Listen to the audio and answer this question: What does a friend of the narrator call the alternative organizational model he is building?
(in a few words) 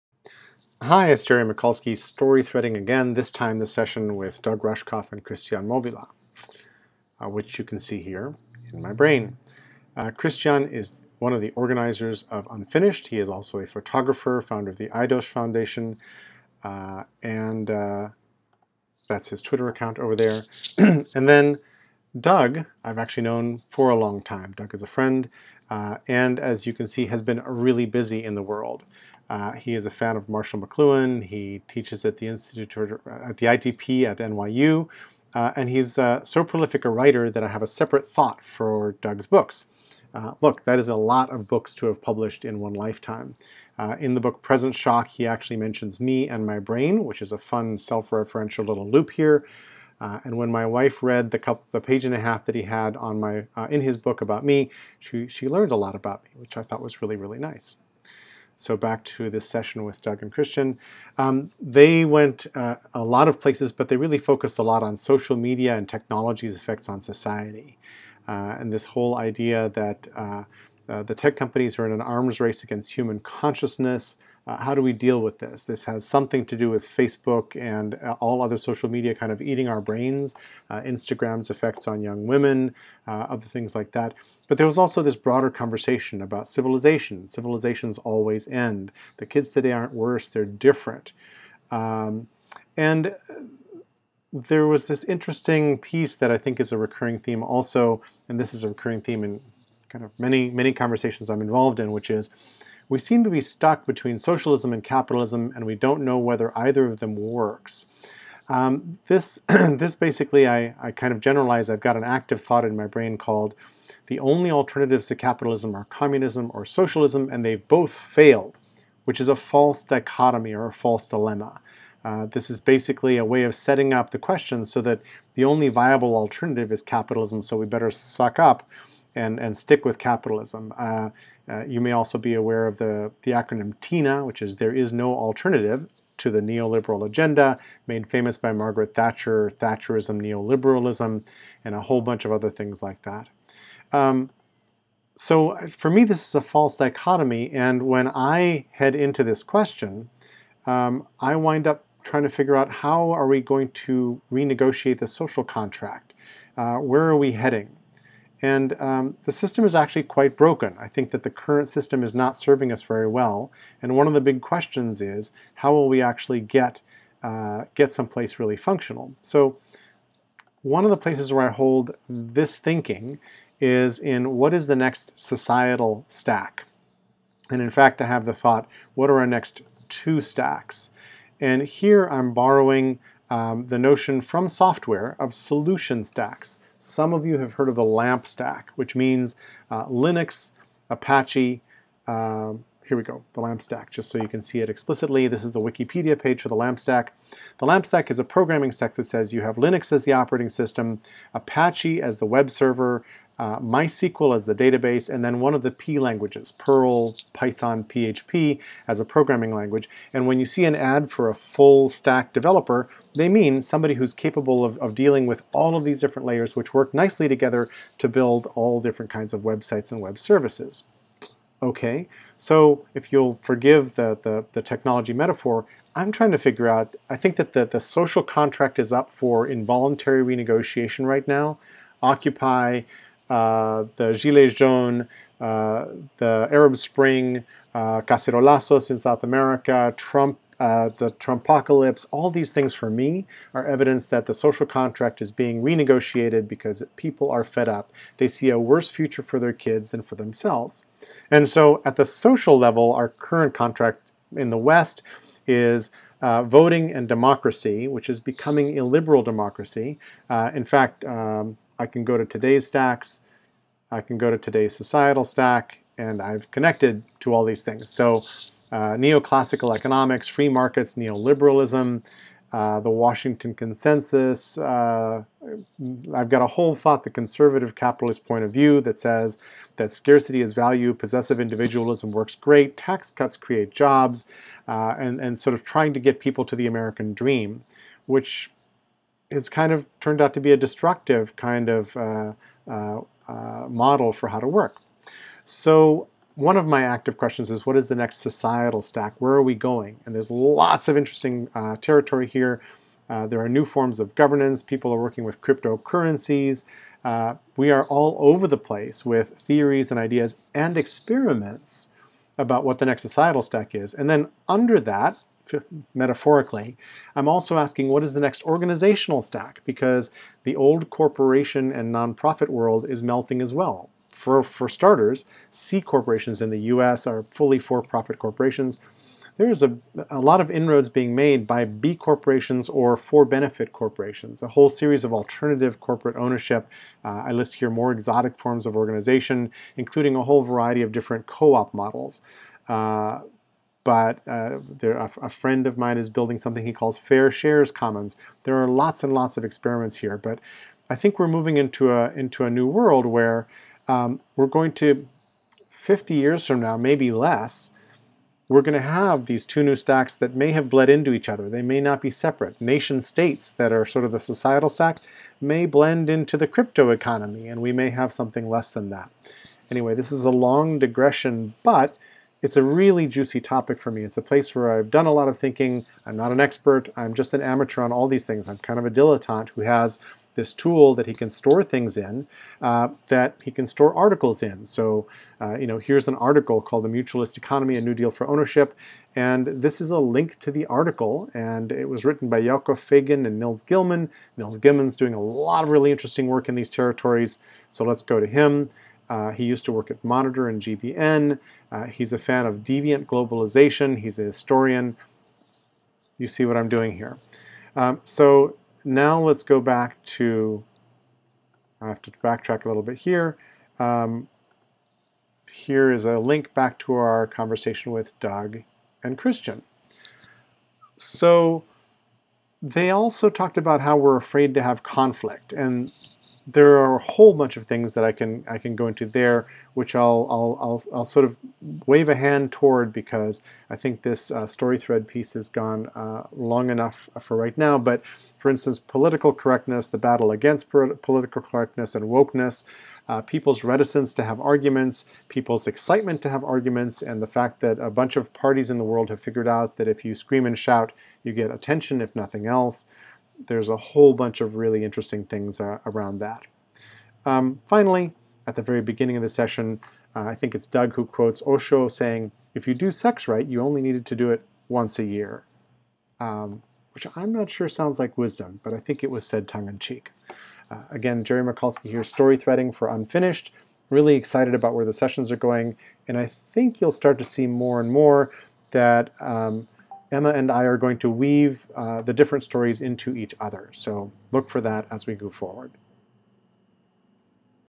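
Fair shares commons.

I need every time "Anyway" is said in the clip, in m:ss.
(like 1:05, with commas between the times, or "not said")
6:09.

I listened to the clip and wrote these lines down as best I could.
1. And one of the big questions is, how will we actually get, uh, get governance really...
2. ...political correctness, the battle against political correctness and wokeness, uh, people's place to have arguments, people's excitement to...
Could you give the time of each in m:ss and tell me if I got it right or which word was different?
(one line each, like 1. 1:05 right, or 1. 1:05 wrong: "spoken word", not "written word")
1. 2:43 wrong: "someplace", not "governance"
2. 7:18 wrong: "reticence", not "place".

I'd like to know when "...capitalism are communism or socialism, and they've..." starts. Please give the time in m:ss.
1:55.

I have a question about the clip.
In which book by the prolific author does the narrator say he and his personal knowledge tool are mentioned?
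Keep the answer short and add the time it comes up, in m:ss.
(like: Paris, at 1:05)
Present Shock, at 0:44.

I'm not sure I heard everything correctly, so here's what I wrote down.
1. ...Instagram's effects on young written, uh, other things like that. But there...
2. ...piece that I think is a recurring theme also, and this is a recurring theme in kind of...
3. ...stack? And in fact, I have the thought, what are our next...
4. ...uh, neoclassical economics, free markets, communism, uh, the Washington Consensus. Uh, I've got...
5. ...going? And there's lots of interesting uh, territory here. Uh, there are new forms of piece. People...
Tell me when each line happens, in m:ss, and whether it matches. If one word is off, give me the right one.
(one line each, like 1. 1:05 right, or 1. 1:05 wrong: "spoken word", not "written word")
1. 1:20 wrong: "women", not "written"
2. 1:35 right
3. 2:56 right
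4. 4:28 wrong: "neoliberalism", not "communism"
5. 4:59 wrong: "governance", not "piece".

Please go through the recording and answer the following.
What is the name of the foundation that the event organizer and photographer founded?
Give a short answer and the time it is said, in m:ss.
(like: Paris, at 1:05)
IDOSH Foundation, at 0:14.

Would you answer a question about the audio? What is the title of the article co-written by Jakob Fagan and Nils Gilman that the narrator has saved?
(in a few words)
The Mutualist Economy.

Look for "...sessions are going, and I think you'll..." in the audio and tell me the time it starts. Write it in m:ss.
7:54.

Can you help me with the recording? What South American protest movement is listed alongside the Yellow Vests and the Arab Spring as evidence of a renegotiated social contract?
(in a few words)
Cacerolazos.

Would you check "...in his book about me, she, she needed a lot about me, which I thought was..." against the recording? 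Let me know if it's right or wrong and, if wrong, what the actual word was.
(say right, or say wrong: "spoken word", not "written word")
wrong: "learned", not "needed".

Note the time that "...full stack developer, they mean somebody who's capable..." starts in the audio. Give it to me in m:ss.
3:31.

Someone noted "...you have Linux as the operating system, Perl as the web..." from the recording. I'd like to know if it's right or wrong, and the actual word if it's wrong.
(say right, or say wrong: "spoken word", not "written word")
wrong: "Apache", not "Perl".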